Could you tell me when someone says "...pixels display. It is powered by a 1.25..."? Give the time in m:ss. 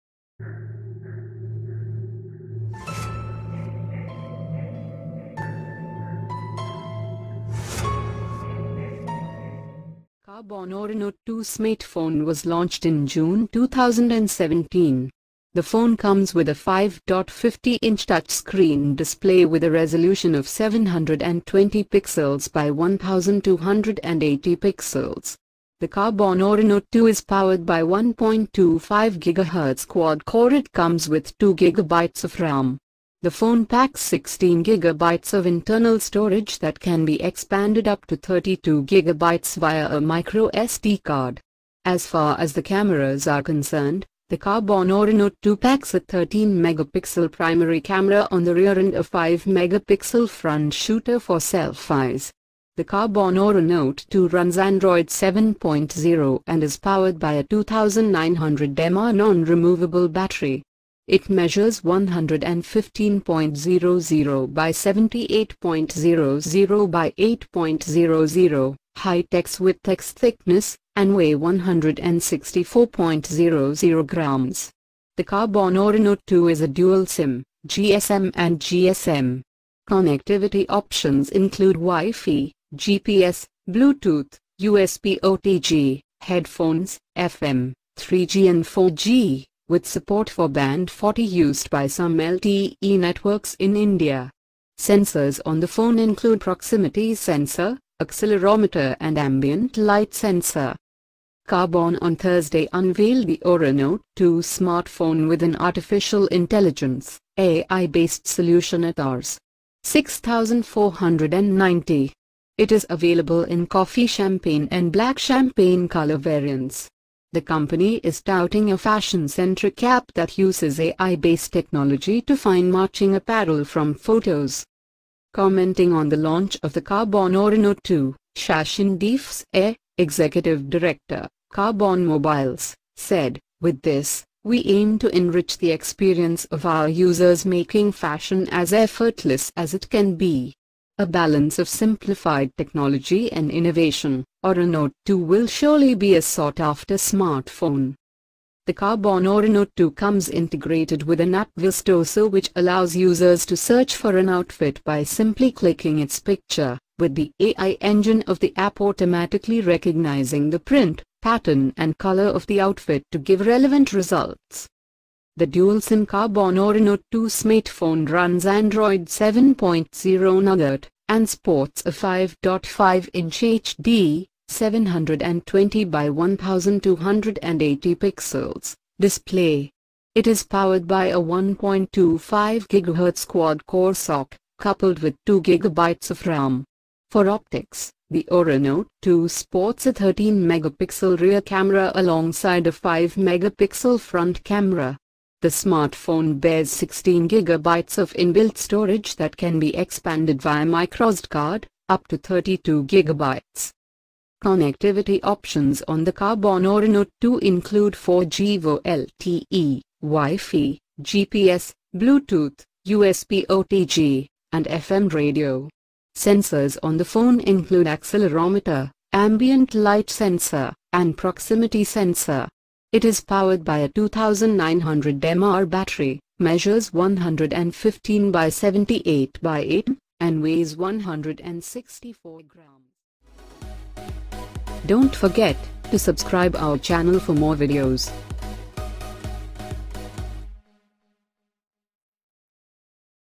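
2:57.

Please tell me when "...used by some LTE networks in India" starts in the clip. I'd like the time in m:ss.
1:31.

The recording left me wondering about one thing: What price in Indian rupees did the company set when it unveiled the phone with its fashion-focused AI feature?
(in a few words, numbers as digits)
Rs. 6490.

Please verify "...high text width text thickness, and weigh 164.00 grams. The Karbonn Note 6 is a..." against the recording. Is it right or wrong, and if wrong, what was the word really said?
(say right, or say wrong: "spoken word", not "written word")
wrong: "2", not "6".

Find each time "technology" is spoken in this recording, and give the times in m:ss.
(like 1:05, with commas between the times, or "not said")
2:01, 2:22.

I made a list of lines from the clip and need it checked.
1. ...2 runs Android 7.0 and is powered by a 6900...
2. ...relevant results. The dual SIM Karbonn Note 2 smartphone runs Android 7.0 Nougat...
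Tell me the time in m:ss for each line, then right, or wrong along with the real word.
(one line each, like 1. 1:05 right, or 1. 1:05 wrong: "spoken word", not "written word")
1. 0:54 wrong: "2900", not "6900"
2. 2:43 right.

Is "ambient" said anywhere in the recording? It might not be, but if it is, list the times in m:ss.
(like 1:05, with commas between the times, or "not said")
1:39, 3:39.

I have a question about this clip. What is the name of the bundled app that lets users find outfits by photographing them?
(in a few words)
Vistoso.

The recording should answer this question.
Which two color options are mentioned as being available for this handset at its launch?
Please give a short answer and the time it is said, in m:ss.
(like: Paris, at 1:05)
coffee champagne and black champagne, at 1:53.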